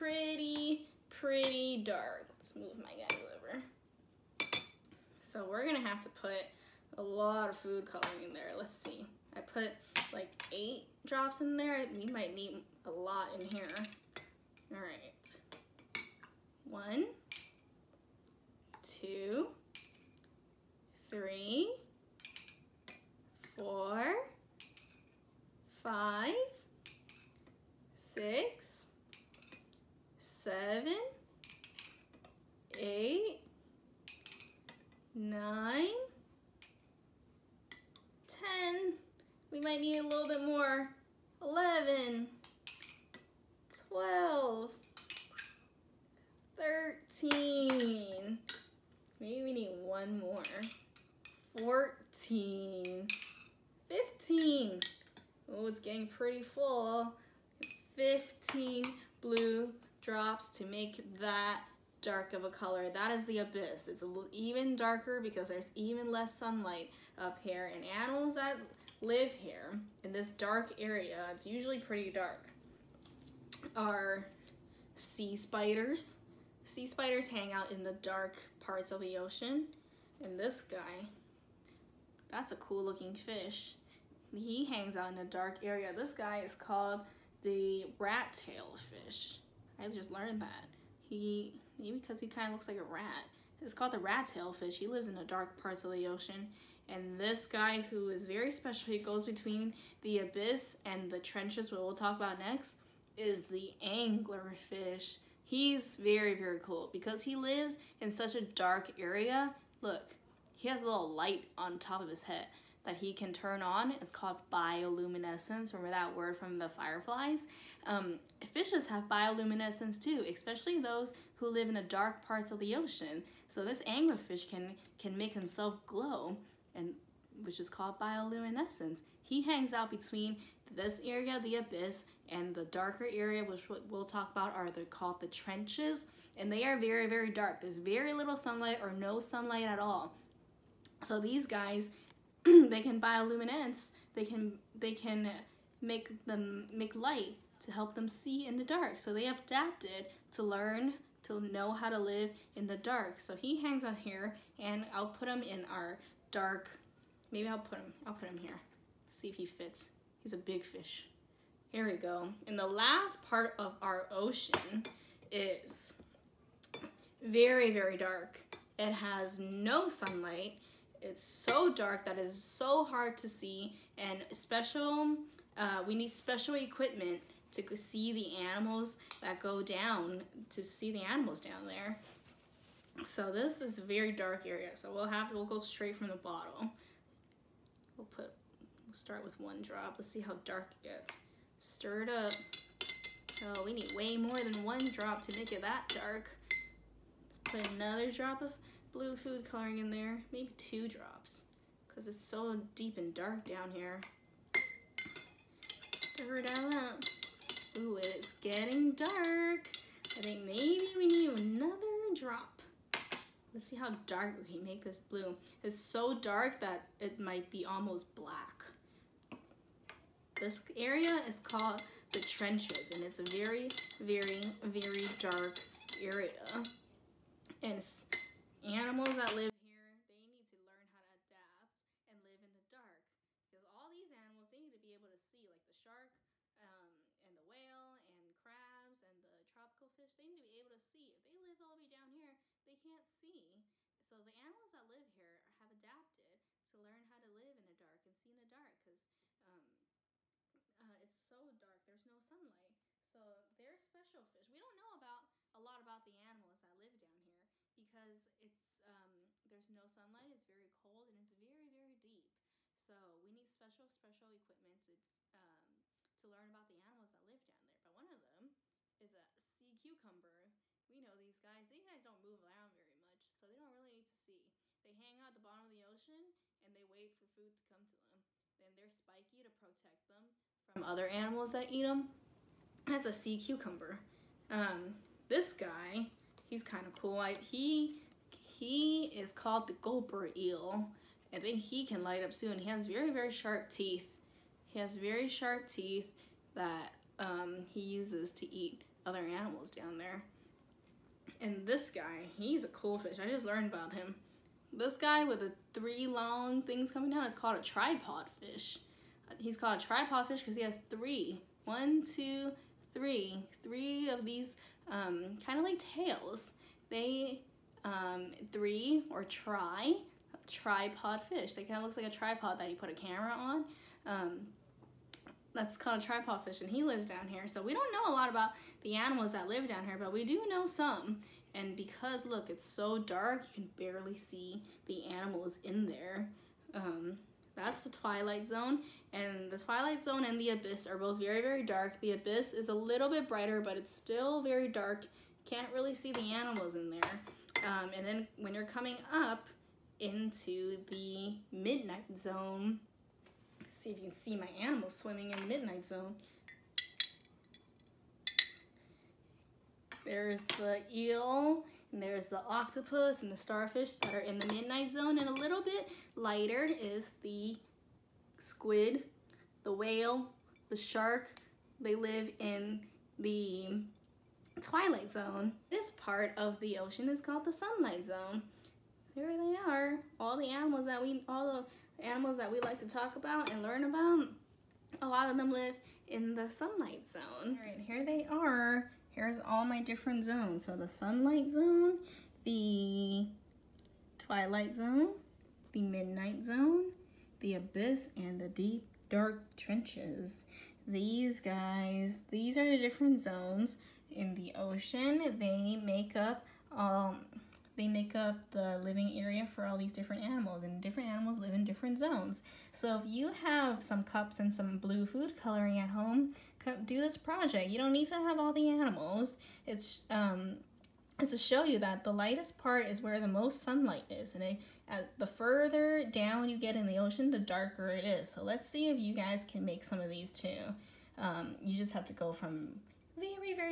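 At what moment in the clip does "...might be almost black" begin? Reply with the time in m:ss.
3:37.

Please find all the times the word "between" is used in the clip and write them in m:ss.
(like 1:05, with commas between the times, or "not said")
1:39, 2:09.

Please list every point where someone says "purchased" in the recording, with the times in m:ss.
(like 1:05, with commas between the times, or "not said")
not said.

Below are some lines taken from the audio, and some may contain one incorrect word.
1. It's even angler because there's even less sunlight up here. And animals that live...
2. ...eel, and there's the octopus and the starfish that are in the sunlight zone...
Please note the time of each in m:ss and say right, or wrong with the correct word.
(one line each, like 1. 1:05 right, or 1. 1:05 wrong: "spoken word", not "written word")
1. 1:03 wrong: "darker", not "angler"
2. 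6:00 wrong: "midnight", not "sunlight".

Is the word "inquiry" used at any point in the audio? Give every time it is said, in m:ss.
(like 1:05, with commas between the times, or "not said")
not said.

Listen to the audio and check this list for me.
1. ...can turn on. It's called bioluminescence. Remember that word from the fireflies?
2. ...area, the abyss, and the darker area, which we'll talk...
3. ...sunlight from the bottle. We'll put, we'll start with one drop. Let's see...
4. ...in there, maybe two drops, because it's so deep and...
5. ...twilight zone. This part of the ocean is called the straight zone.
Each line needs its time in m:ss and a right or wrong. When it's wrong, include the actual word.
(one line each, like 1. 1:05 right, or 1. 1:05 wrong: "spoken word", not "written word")
1. 1:53 right
2. 2:11 right
3. 3:05 wrong: "straight", not "sunlight"
4. 3:19 right
5. 6:14 wrong: "sunlight", not "straight".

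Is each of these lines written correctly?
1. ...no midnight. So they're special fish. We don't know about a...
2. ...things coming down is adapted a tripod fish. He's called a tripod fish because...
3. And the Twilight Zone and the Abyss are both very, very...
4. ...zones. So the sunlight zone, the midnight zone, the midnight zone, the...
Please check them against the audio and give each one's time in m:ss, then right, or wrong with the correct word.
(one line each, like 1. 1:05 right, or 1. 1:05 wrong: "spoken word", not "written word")
1. 4:12 wrong: "sunlight", not "midnight"
2. 5:06 wrong: "called", not "adapted"
3. 5:39 right
4. 6:30 wrong: "twilight", not "midnight".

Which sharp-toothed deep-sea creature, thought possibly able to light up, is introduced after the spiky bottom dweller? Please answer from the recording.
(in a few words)
Gulper eel.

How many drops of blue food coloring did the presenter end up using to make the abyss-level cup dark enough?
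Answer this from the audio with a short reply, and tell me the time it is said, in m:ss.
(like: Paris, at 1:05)
15, at 0:57.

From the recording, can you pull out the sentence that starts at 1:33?
It's called the rat tail fish.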